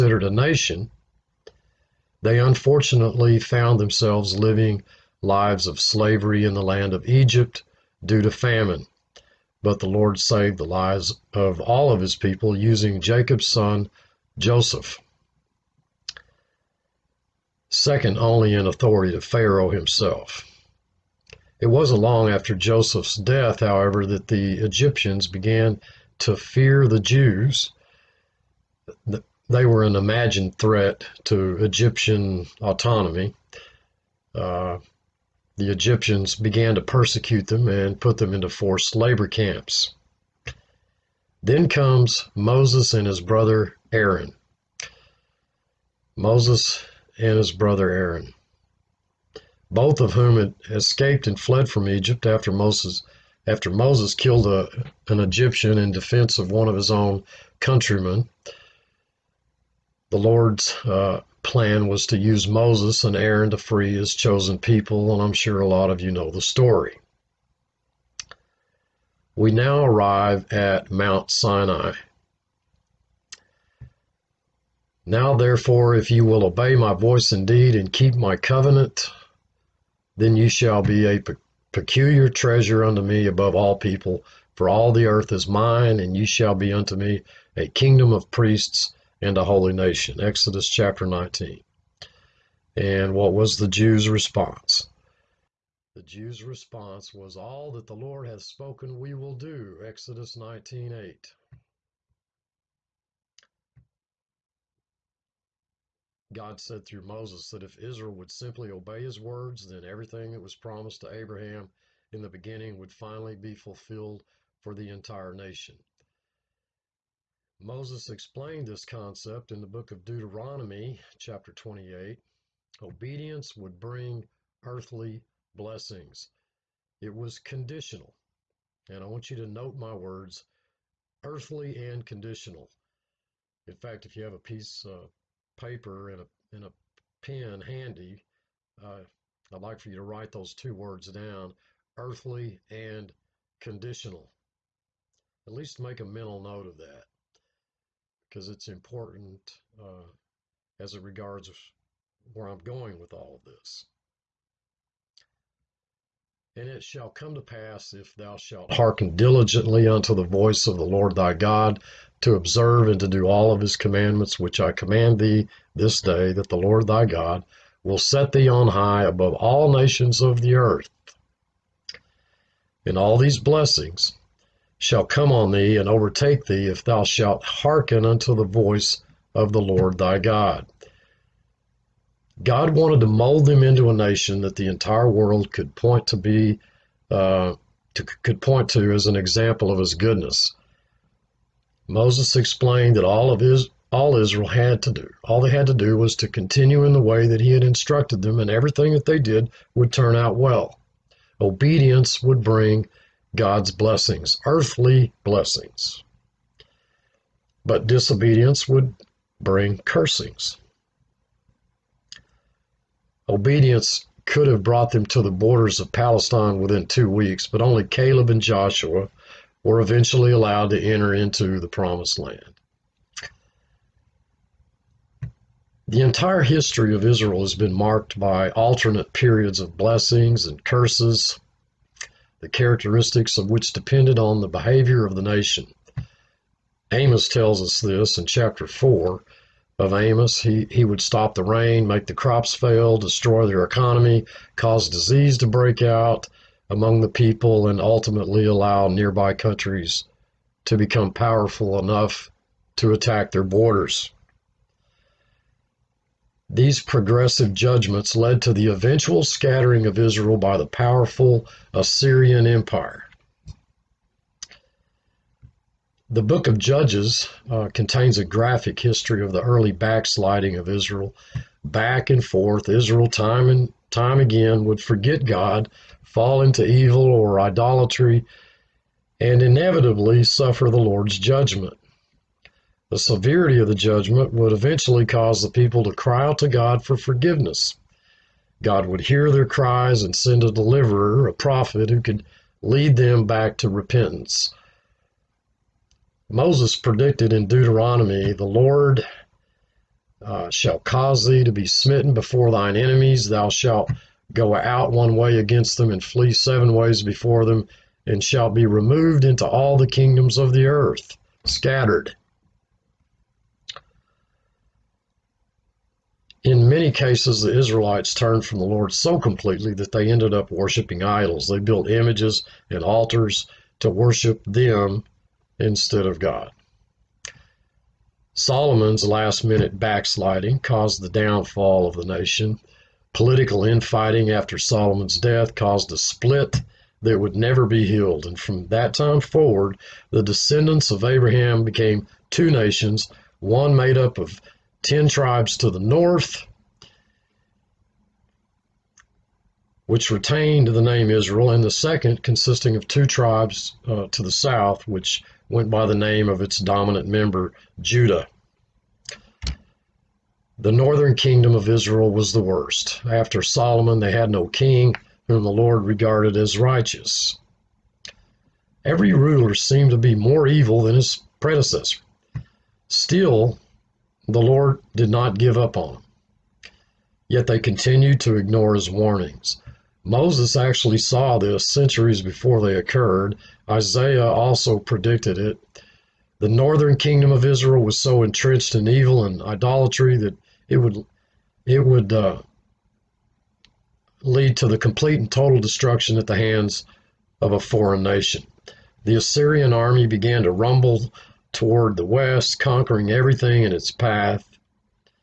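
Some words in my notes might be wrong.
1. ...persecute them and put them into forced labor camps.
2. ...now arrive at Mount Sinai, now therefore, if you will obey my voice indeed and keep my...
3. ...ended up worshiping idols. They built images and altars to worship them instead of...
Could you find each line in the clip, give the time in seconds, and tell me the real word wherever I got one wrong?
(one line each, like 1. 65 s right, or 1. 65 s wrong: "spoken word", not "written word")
1. 36 s right
2. 69 s right
3. 320 s right.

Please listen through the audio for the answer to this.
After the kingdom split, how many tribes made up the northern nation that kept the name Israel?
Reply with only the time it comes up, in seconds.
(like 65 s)
344 s.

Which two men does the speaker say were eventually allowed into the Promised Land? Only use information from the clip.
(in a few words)
Caleb and Joshua.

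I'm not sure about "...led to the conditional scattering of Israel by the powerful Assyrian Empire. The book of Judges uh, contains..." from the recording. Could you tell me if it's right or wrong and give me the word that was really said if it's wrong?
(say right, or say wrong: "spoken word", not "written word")
wrong: "eventual", not "conditional".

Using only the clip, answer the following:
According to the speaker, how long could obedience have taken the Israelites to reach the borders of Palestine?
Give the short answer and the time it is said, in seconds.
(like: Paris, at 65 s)
two weeks, at 216 s.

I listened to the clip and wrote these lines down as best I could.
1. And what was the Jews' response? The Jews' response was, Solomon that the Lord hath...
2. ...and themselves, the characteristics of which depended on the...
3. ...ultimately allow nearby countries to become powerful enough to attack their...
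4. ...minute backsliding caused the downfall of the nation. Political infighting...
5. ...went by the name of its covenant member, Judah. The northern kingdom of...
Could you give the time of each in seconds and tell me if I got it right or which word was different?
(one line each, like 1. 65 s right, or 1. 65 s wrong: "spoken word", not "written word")
1. 92 s wrong: "All", not "Solomon"
2. 230 s wrong: "curses", not "themselves"
3. 247 s right
4. 329 s right
5. 355 s wrong: "dominant", not "covenant".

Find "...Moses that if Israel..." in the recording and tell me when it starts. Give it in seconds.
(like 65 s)
107 s.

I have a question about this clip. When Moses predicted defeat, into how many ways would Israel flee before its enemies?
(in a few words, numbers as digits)
7.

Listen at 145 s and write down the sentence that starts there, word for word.
At least make a mental note of that because it's important uh, as it regards where I'm going with all of this.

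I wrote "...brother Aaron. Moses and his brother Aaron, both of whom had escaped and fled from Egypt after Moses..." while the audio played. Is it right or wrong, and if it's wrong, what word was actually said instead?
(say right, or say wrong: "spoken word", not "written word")
right.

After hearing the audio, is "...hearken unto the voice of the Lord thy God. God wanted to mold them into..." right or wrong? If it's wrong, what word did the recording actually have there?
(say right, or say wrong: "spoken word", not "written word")
right.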